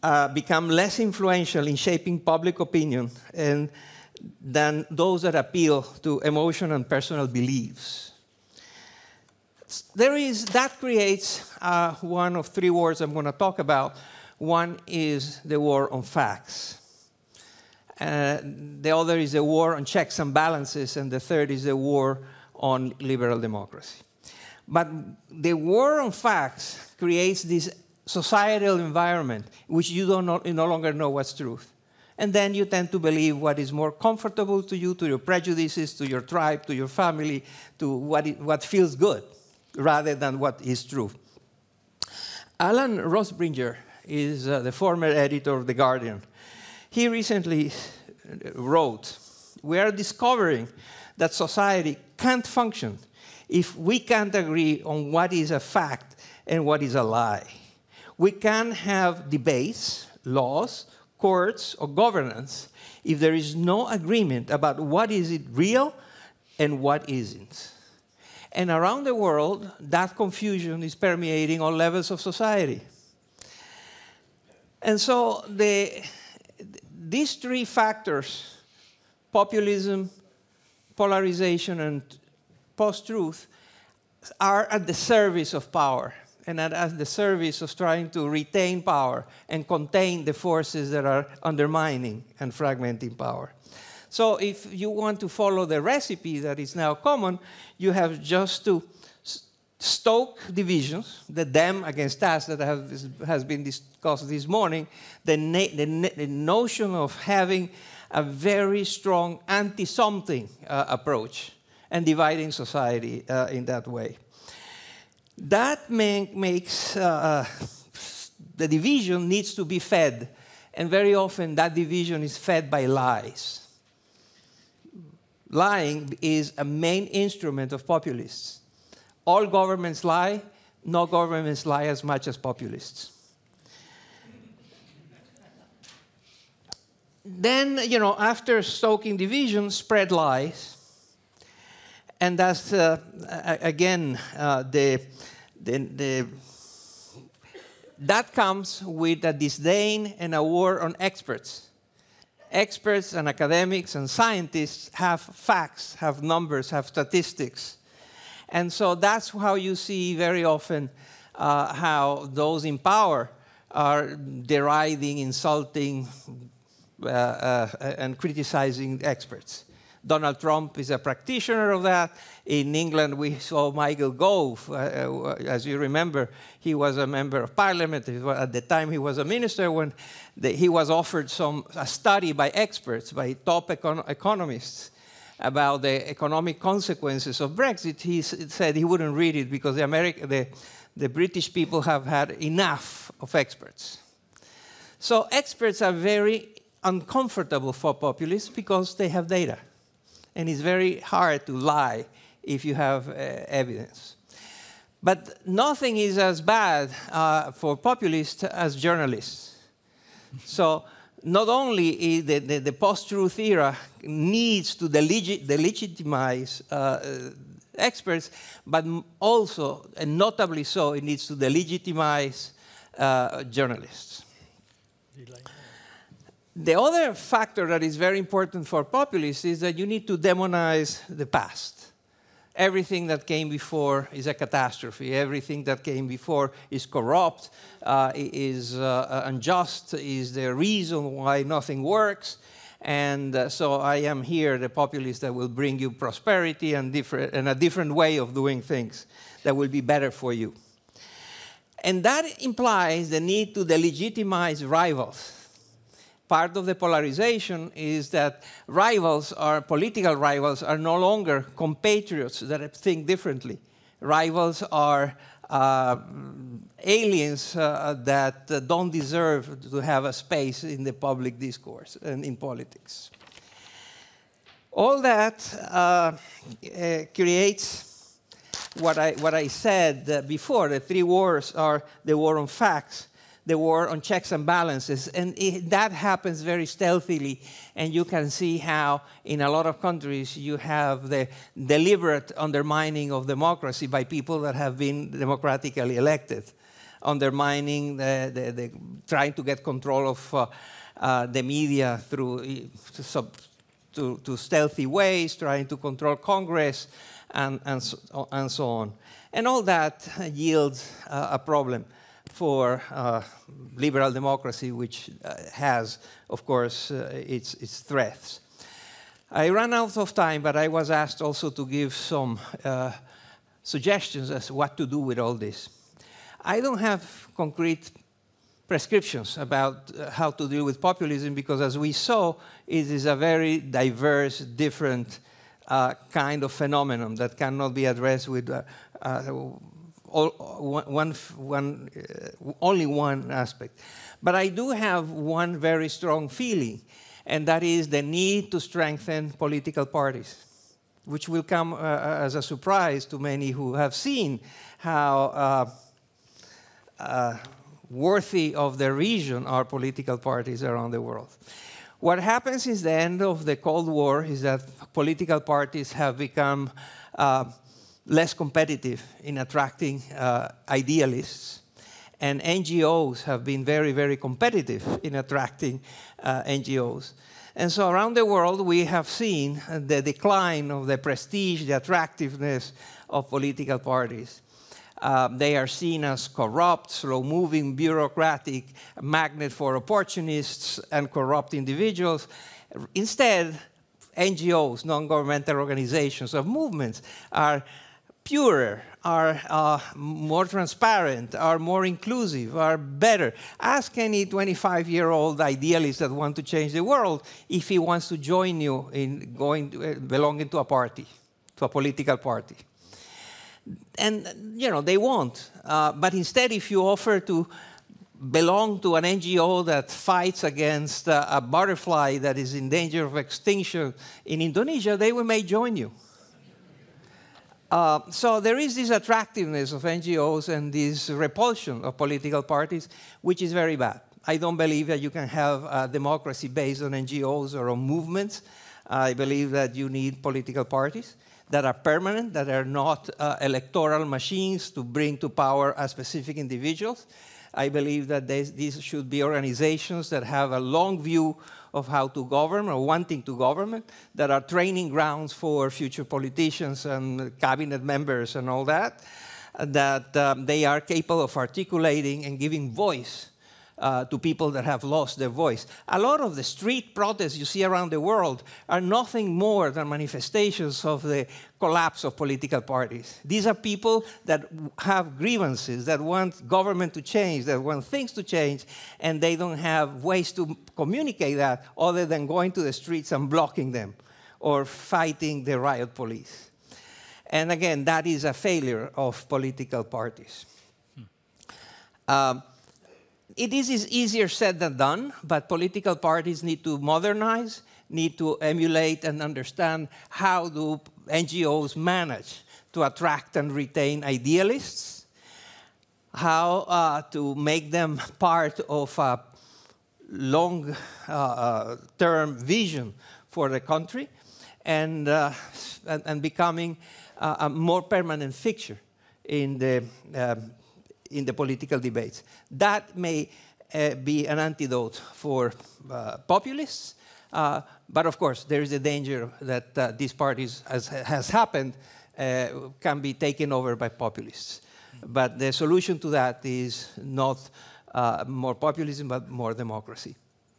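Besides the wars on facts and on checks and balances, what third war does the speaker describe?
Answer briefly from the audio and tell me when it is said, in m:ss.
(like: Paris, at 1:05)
war on liberal democracy, at 0:21.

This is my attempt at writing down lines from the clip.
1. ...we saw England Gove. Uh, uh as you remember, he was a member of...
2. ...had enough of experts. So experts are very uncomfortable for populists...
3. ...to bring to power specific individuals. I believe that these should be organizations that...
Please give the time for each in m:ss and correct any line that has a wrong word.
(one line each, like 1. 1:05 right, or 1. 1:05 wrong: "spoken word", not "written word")
1. 2:53 wrong: "Michael", not "England"
2. 3:12 right
3. 7:24 right.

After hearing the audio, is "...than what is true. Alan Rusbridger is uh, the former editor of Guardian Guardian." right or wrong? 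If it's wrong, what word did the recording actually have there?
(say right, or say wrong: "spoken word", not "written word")
wrong: "The", not "Guardian".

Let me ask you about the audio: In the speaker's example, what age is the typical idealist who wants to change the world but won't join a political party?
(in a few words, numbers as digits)
25.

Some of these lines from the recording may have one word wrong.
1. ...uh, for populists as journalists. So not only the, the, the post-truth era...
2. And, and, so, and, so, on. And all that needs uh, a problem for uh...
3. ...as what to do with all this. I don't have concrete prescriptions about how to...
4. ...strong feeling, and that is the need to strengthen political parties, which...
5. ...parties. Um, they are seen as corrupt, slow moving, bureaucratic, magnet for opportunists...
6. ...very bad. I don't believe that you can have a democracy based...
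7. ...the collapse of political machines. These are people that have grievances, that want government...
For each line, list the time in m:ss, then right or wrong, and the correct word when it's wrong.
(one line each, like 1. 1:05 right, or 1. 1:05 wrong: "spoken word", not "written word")
1. 3:27 right
2. 5:07 wrong: "yields", not "needs"
3. 5:24 right
4. 5:45 right
5. 6:23 right
6. 7:13 right
7. 7:51 wrong: "parties", not "machines".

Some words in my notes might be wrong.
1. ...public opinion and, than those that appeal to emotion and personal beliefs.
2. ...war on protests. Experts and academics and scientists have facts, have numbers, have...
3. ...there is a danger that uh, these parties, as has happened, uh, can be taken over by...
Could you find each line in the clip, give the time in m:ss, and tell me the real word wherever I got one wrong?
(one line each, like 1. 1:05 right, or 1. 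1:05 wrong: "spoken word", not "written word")
1. 0:02 right
2. 2:30 wrong: "experts", not "protests"
3. 8:48 right.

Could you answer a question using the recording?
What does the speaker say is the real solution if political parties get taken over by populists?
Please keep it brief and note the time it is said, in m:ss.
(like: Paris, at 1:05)
more democracy, at 8:59.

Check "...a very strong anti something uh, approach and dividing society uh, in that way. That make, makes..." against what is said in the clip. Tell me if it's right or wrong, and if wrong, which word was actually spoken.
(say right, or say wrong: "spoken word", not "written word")
right.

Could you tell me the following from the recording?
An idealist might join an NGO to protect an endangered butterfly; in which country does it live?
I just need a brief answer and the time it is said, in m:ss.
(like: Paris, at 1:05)
Indonesia, at 7:04.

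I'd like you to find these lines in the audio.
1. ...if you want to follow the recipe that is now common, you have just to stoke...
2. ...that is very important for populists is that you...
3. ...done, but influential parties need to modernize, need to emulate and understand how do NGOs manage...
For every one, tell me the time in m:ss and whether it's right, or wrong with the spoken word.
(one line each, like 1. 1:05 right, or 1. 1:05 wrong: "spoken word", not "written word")
1. 1:34 right
2. 3:47 right
3. 8:14 wrong: "political", not "influential".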